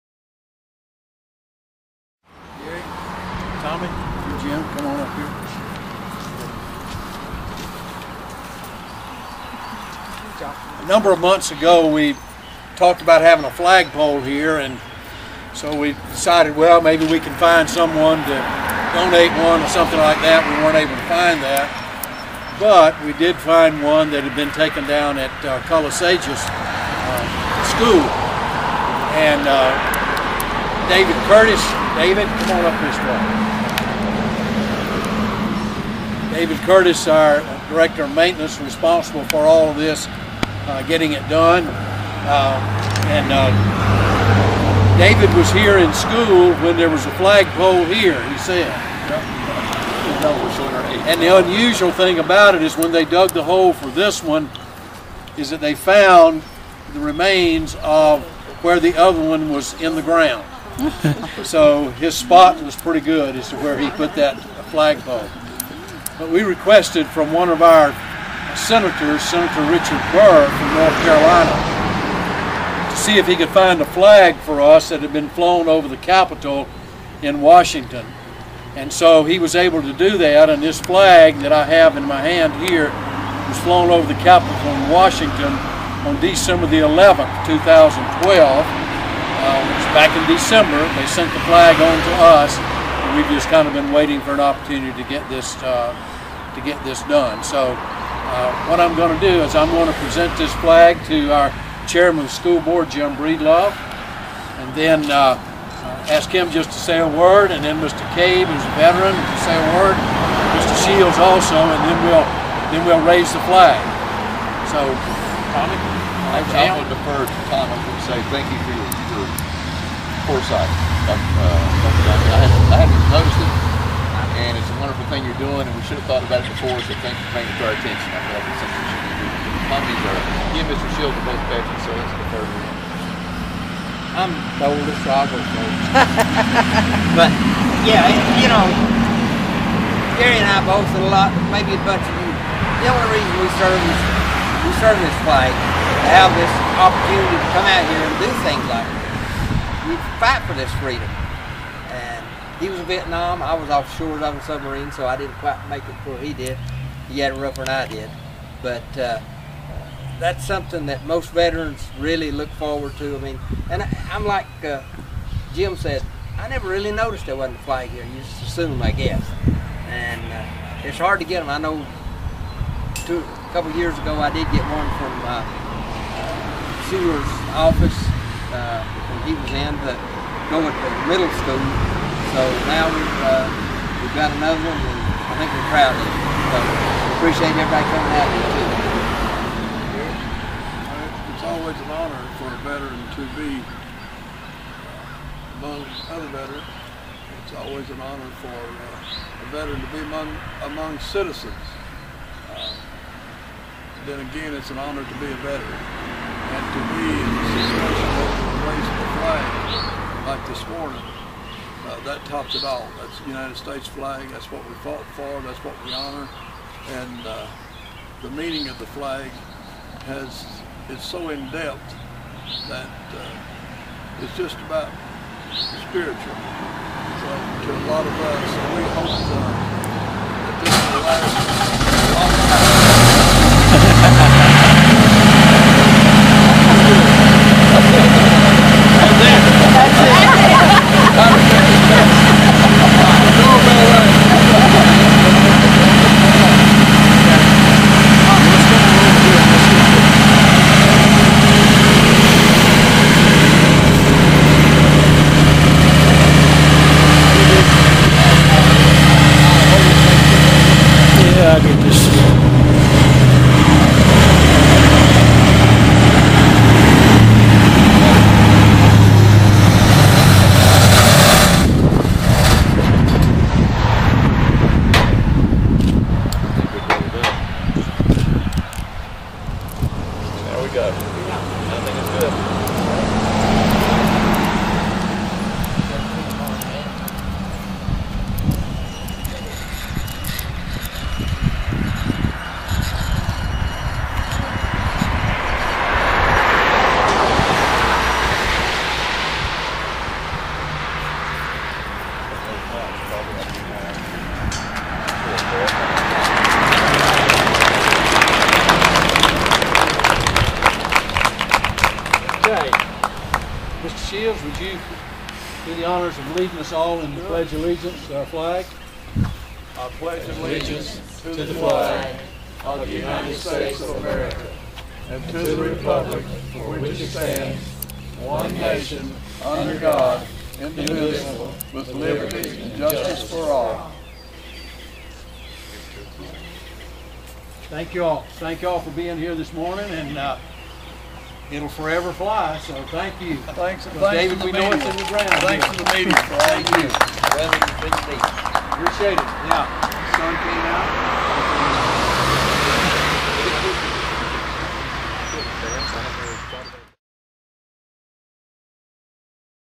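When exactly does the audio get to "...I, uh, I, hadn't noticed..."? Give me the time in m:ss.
2:00.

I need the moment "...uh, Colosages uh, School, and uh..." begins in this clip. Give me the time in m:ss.
0:25.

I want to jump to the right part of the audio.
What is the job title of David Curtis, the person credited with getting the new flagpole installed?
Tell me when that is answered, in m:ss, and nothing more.
0:37.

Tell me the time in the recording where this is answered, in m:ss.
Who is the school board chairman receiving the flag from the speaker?
1:42.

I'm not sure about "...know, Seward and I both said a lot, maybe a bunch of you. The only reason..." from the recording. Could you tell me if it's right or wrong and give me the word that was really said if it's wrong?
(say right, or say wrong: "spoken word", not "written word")
wrong: "Gary", not "Seward".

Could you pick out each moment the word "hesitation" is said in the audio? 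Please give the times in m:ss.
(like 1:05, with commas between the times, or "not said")
not said.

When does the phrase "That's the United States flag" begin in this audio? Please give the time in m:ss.
3:32.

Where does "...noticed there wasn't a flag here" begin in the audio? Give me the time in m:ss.
2:46.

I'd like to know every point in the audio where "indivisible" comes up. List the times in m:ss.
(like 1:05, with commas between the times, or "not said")
5:30.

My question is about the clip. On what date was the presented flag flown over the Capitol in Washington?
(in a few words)
December 11, 2012.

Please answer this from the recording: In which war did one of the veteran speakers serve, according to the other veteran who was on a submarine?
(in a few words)
Vietnam.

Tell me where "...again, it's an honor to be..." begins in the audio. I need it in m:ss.
3:24.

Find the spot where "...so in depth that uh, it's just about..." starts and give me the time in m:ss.
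3:41.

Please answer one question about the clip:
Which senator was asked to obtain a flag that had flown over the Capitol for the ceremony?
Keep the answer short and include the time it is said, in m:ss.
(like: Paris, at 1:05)
Richard Burr, at 1:09.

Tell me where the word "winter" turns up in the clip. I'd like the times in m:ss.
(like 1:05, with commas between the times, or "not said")
not said.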